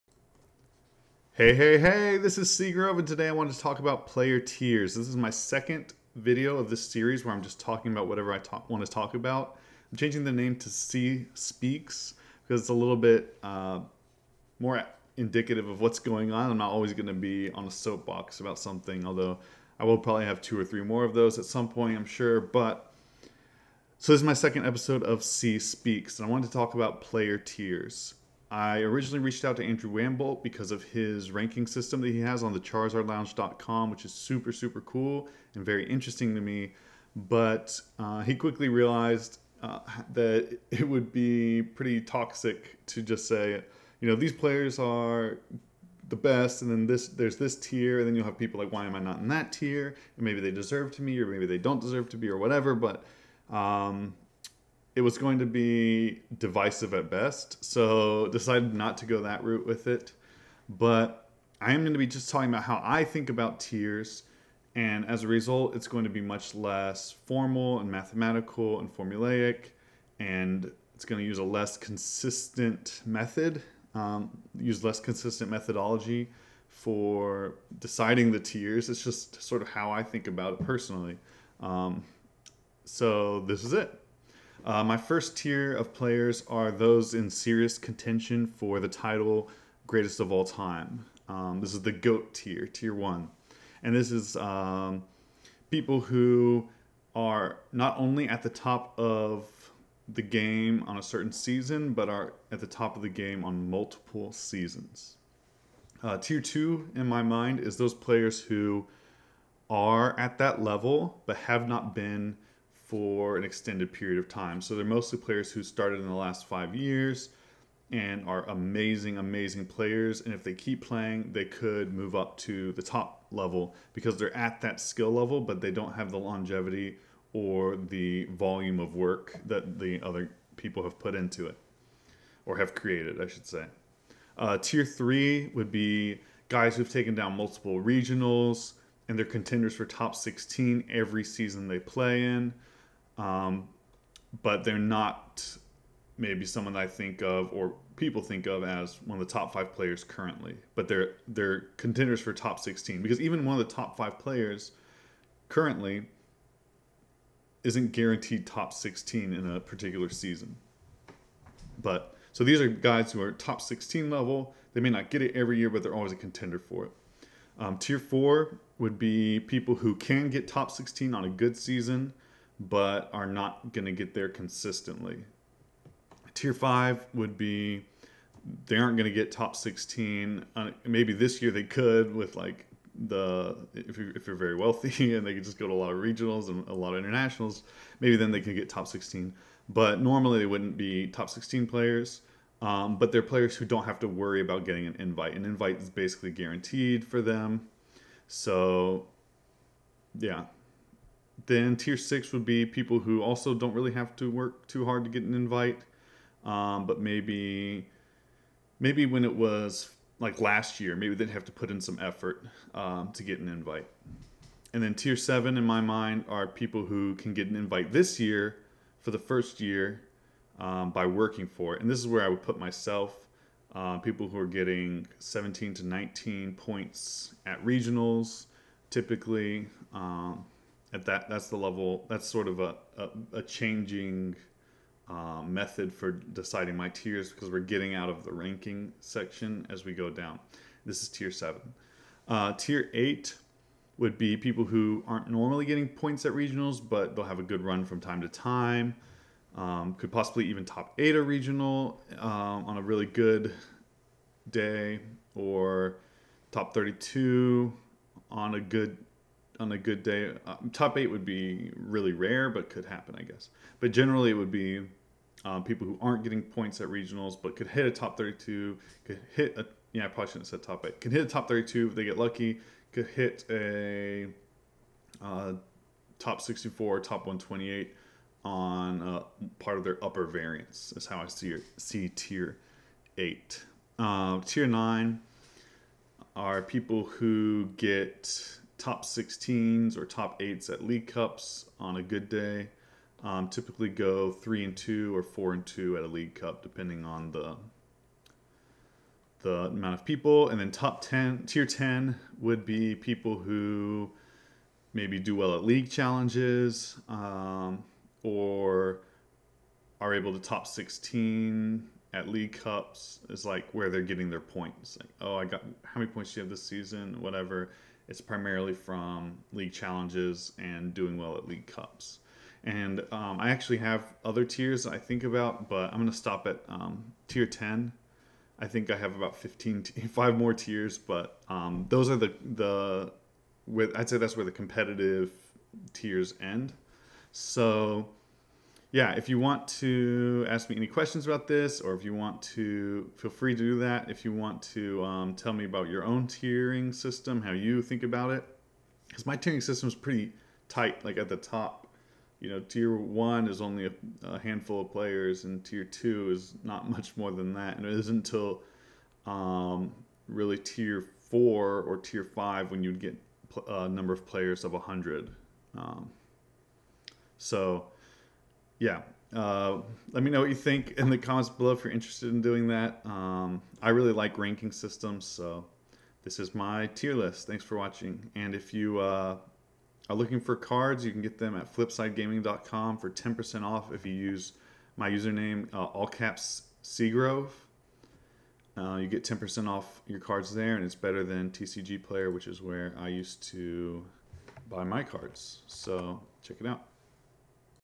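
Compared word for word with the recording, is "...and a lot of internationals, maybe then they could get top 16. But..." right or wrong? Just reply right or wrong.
right.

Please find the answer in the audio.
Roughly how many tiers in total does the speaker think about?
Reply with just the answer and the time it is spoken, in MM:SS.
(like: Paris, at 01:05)
15, at 05:29.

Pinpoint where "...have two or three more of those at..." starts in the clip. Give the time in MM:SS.
00:20.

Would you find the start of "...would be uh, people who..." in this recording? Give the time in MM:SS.
04:24.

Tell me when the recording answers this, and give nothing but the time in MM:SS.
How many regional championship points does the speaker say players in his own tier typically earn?
03:45.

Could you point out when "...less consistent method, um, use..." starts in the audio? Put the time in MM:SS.
01:11.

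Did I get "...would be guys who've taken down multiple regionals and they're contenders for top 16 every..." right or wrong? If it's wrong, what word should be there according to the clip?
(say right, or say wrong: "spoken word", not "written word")
right.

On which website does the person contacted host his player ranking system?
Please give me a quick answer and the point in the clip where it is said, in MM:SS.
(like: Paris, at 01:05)
CharizardLounge.com, at 00:32.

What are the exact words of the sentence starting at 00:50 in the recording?
And maybe they deserve to be, or maybe they don't deserve to be, or whatever.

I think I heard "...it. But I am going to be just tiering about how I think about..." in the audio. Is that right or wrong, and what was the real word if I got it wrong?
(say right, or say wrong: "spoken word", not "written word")
wrong: "talking", not "tiering".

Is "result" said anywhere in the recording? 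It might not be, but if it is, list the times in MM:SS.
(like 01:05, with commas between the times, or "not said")
01:05.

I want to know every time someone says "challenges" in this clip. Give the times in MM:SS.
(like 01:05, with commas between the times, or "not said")
05:05, 05:19.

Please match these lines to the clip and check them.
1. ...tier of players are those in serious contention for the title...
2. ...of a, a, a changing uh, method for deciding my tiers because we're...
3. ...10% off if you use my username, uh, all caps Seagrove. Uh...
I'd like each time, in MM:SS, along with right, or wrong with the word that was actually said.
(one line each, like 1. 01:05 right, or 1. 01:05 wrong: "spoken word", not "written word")
1. 01:25 right
2. 03:52 right
3. 06:23 right.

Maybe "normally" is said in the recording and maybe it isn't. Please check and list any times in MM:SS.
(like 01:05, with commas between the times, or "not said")
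03:10, 04:05.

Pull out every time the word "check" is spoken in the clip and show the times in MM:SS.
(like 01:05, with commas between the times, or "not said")
06:36.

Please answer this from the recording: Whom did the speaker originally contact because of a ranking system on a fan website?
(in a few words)
Andrew Wamboldt.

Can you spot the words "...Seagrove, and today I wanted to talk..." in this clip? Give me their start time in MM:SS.
00:02.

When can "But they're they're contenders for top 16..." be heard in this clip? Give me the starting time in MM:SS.
02:30.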